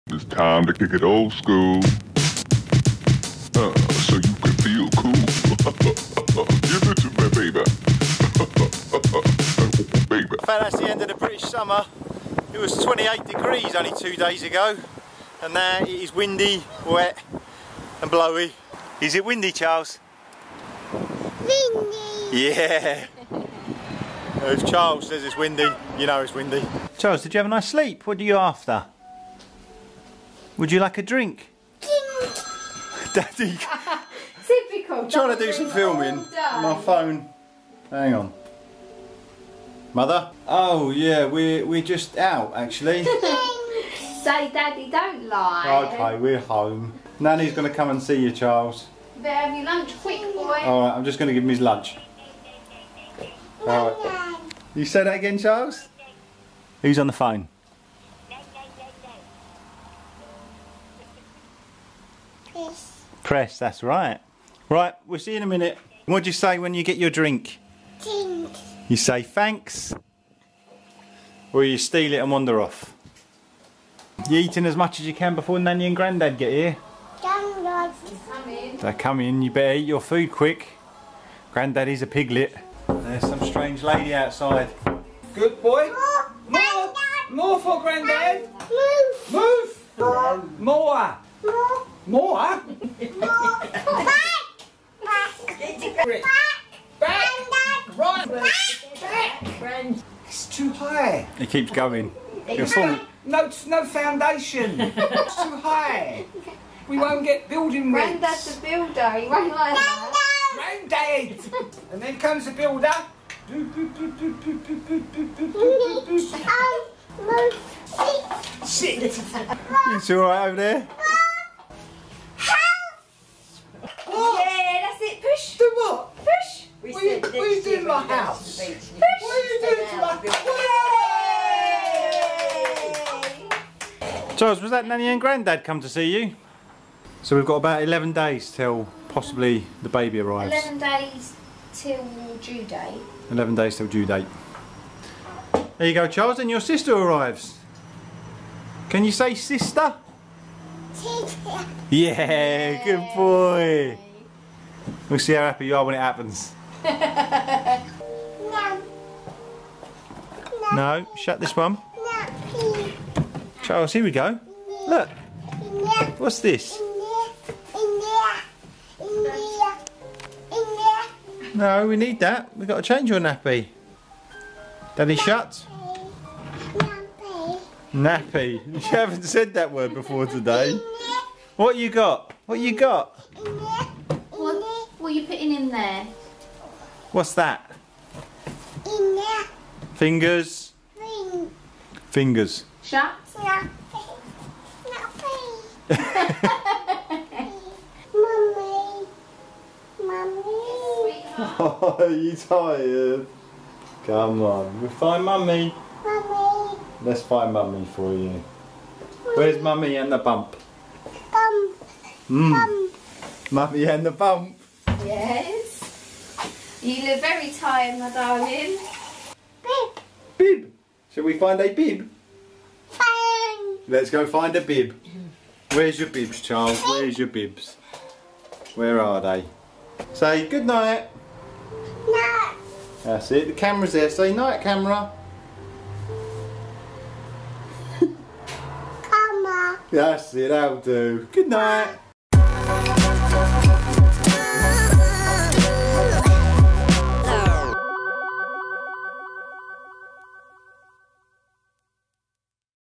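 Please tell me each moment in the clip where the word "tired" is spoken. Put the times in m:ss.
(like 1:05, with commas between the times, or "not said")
3:22, 3:37.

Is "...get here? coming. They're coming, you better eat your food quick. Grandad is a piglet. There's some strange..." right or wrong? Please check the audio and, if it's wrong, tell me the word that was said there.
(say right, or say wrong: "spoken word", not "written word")
right.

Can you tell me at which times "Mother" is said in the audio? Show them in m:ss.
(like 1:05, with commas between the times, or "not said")
0:39.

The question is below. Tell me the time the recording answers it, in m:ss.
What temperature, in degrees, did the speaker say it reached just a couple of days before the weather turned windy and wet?
0:12.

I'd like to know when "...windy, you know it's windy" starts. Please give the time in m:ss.
0:25.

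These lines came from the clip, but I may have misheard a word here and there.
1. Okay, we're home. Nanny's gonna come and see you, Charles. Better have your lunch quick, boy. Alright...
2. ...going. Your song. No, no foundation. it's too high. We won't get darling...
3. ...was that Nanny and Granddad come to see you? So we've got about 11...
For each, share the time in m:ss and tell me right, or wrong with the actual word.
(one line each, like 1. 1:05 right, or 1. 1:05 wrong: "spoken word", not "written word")
1. 0:45 right
2. 1:41 wrong: "building", not "darling"
3. 2:14 right.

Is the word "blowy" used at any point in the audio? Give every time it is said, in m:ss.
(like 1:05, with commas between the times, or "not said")
0:18.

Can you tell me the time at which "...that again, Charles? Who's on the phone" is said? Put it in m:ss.
0:55.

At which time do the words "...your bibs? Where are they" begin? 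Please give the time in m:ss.
3:47.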